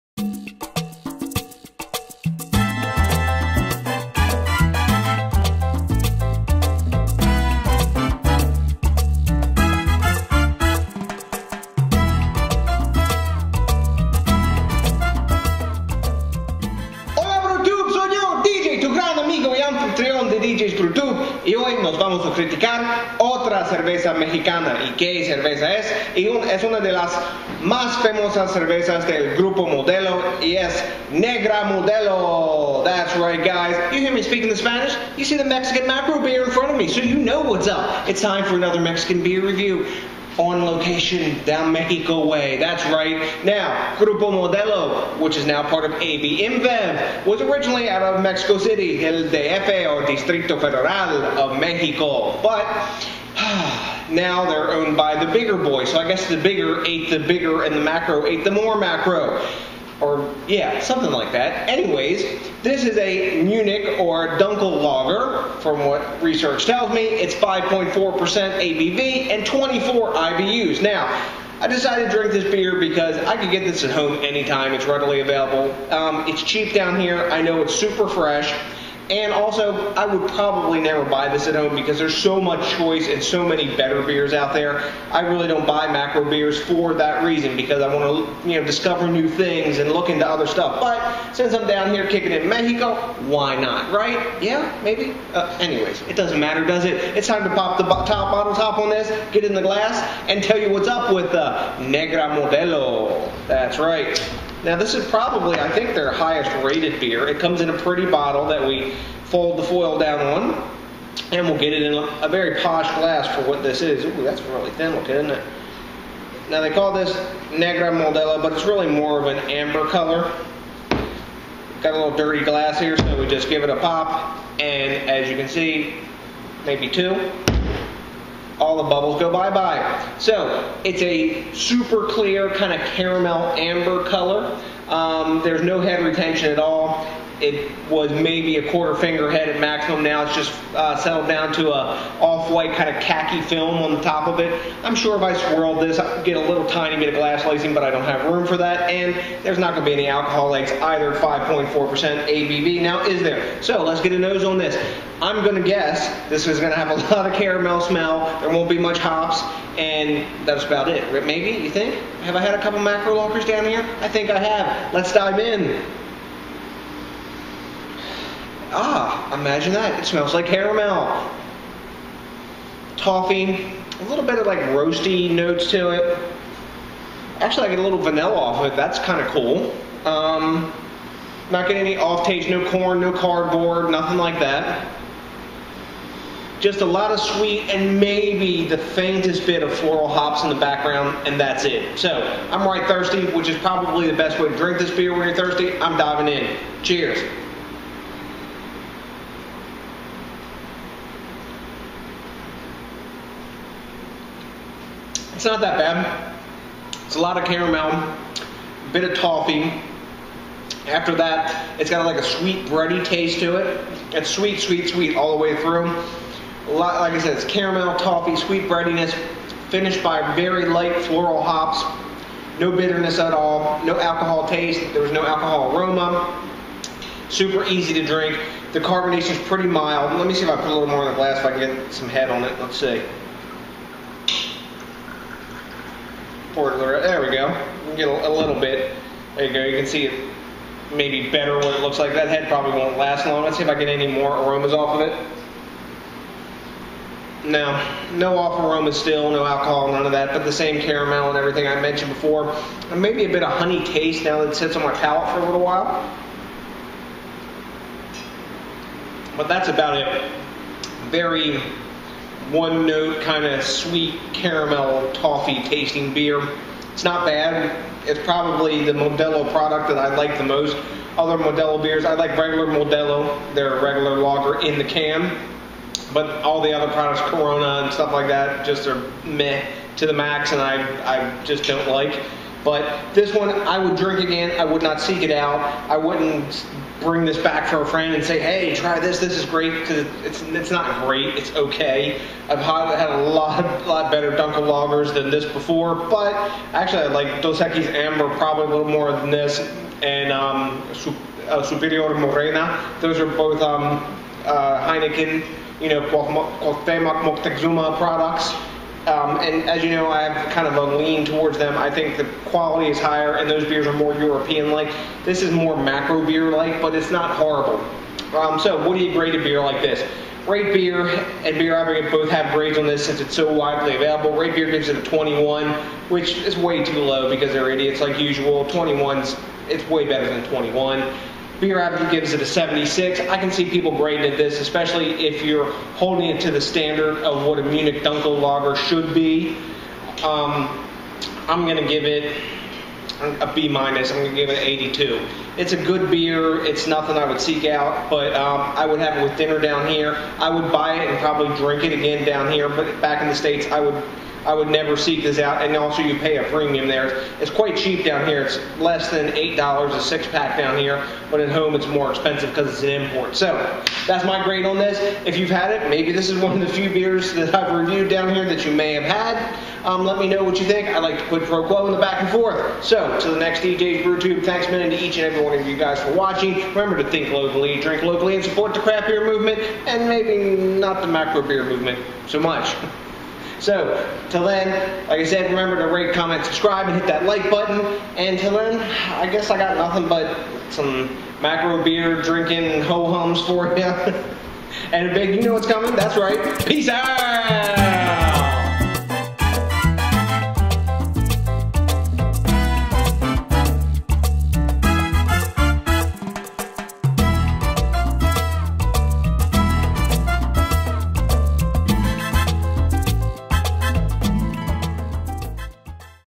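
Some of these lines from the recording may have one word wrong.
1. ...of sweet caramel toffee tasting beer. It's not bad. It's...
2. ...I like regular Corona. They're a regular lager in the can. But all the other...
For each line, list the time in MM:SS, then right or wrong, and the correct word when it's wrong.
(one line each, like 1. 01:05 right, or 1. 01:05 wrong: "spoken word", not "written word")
1. 04:23 right
2. 04:32 wrong: "Modelo", not "Corona".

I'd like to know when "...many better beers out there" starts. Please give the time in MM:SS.
01:23.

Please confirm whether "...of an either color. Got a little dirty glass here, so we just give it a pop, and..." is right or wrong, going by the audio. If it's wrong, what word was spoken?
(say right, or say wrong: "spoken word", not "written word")
wrong: "amber", not "either".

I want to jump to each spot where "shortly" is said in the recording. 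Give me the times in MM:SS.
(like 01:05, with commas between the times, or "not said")
not said.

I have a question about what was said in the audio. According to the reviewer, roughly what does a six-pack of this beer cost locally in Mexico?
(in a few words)
less than $8.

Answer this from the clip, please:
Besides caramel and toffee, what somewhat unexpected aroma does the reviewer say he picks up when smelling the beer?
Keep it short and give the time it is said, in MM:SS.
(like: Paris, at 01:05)
vanilla, at 02:58.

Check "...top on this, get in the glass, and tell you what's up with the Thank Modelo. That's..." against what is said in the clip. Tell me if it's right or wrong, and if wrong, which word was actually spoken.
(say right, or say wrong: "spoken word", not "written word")
wrong: "Negra", not "Thank".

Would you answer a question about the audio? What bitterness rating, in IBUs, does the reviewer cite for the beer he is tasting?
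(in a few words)
24.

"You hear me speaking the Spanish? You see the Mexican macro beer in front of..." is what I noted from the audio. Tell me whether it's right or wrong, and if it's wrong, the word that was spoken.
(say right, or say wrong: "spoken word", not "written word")
right.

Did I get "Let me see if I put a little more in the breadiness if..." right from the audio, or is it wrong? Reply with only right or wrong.
wrong.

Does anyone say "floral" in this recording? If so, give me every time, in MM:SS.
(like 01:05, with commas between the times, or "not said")
03:09, 03:41.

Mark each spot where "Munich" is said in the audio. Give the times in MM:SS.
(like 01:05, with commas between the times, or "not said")
01:03, 05:37.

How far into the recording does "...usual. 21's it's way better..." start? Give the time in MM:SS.
05:28.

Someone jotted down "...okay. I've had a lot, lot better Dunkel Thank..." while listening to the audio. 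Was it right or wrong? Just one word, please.
wrong.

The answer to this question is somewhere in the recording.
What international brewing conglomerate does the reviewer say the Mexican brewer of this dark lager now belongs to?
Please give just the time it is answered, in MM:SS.
00:46.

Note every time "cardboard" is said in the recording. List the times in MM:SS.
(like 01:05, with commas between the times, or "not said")
03:03.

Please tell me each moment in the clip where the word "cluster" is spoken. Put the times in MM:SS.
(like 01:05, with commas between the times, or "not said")
not said.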